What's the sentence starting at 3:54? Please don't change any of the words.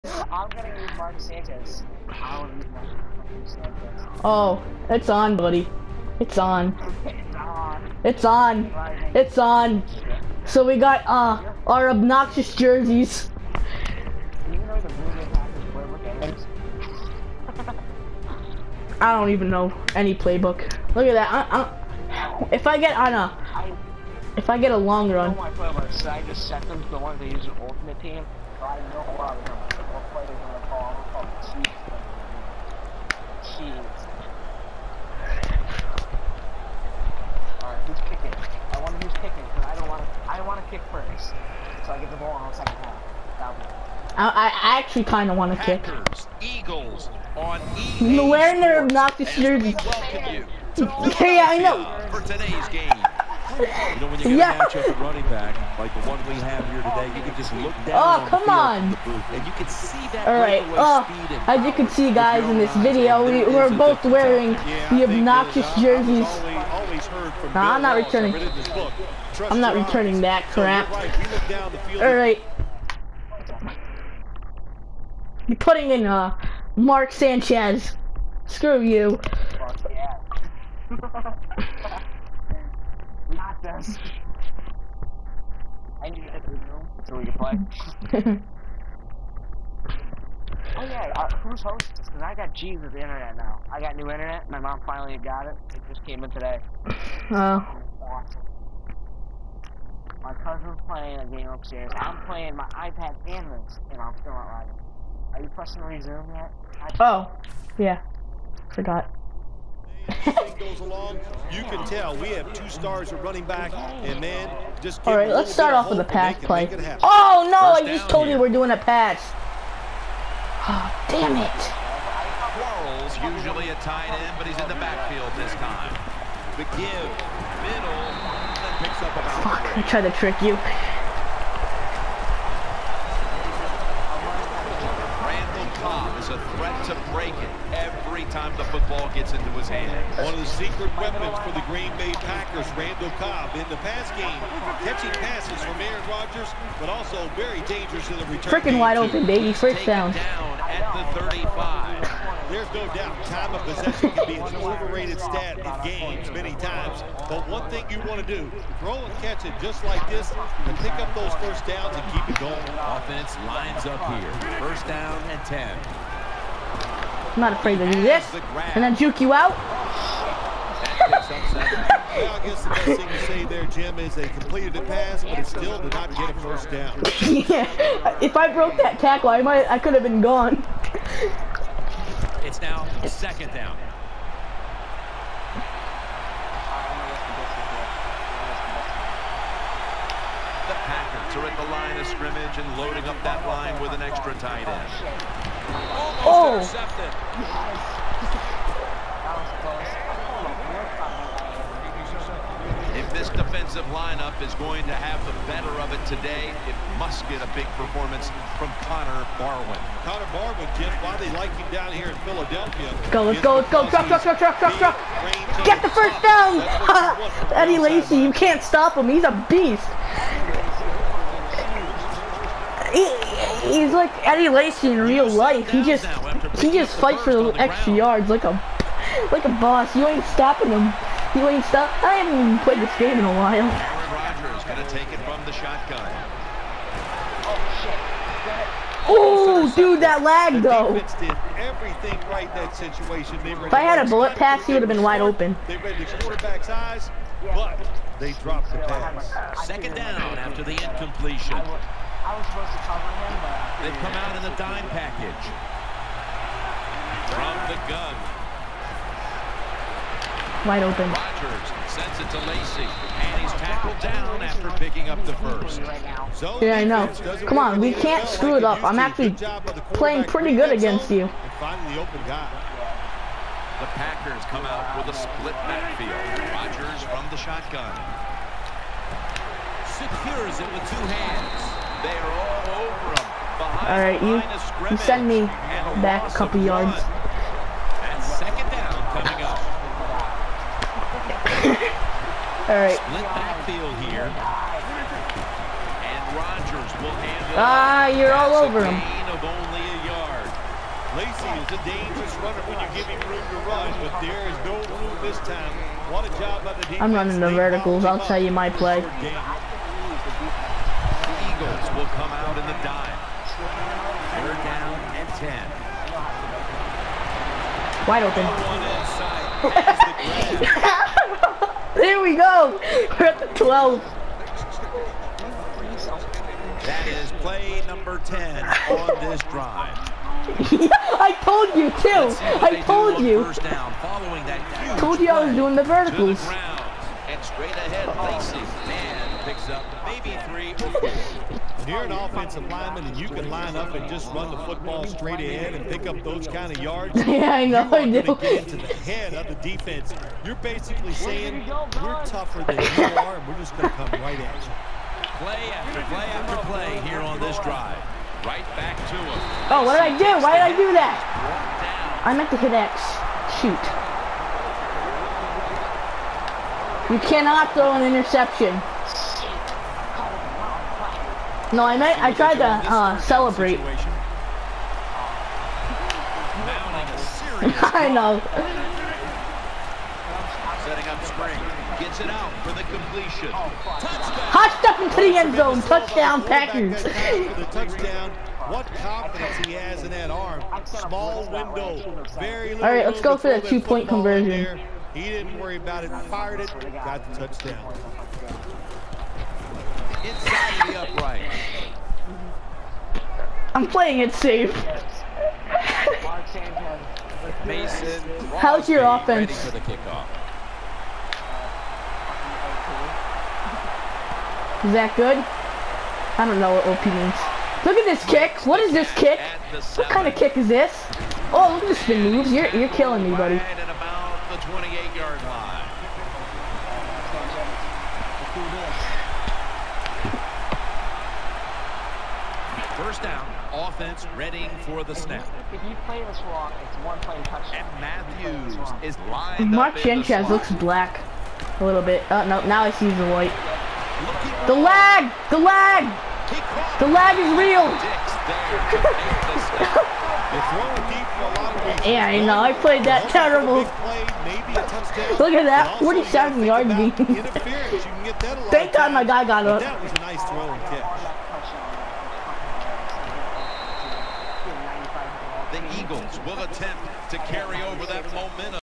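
Rodgers gonna take it from the shotgun.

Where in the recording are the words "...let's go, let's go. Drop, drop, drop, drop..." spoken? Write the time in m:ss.
3:33.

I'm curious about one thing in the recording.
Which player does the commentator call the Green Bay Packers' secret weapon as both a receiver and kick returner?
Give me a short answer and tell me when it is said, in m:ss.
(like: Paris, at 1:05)
Randall Cobb, at 2:22.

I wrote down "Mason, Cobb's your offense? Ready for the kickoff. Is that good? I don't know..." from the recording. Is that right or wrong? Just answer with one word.
wrong.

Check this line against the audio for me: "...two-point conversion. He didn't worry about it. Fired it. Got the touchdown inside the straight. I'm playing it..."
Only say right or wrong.
wrong.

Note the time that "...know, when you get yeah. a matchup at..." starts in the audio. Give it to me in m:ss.
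0:54.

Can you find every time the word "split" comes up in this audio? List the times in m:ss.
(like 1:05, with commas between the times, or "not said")
4:35, 4:52.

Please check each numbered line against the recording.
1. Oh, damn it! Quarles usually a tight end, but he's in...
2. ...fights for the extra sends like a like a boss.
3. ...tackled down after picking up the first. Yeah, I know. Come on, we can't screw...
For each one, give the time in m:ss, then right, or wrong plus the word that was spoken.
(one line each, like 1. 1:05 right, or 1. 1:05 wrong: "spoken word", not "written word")
1. 2:00 right
2. 3:46 wrong: "yards", not "sends"
3. 4:23 right.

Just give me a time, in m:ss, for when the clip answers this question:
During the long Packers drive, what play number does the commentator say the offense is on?
5:27.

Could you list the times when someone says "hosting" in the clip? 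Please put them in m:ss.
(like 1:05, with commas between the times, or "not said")
1:31.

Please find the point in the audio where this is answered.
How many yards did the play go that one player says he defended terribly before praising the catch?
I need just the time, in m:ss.
7:35.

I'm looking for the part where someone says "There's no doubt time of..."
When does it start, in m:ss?
2:32.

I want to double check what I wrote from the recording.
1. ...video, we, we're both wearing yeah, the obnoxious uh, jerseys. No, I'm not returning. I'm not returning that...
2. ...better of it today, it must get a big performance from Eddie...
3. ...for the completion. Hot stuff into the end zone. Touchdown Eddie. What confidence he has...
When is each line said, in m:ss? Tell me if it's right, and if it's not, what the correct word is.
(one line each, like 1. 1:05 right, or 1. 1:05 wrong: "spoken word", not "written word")
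1. 1:02 right
2. 3:25 wrong: "Connor", not "Eddie"
3. 6:22 wrong: "Packers", not "Eddie".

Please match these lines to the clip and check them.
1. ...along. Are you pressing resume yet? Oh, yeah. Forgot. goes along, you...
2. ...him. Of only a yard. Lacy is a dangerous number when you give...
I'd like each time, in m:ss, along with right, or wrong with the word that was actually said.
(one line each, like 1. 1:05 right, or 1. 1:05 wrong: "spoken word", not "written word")
1. 1:44 wrong: "writing", not "along"
2. 4:58 wrong: "runner", not "number".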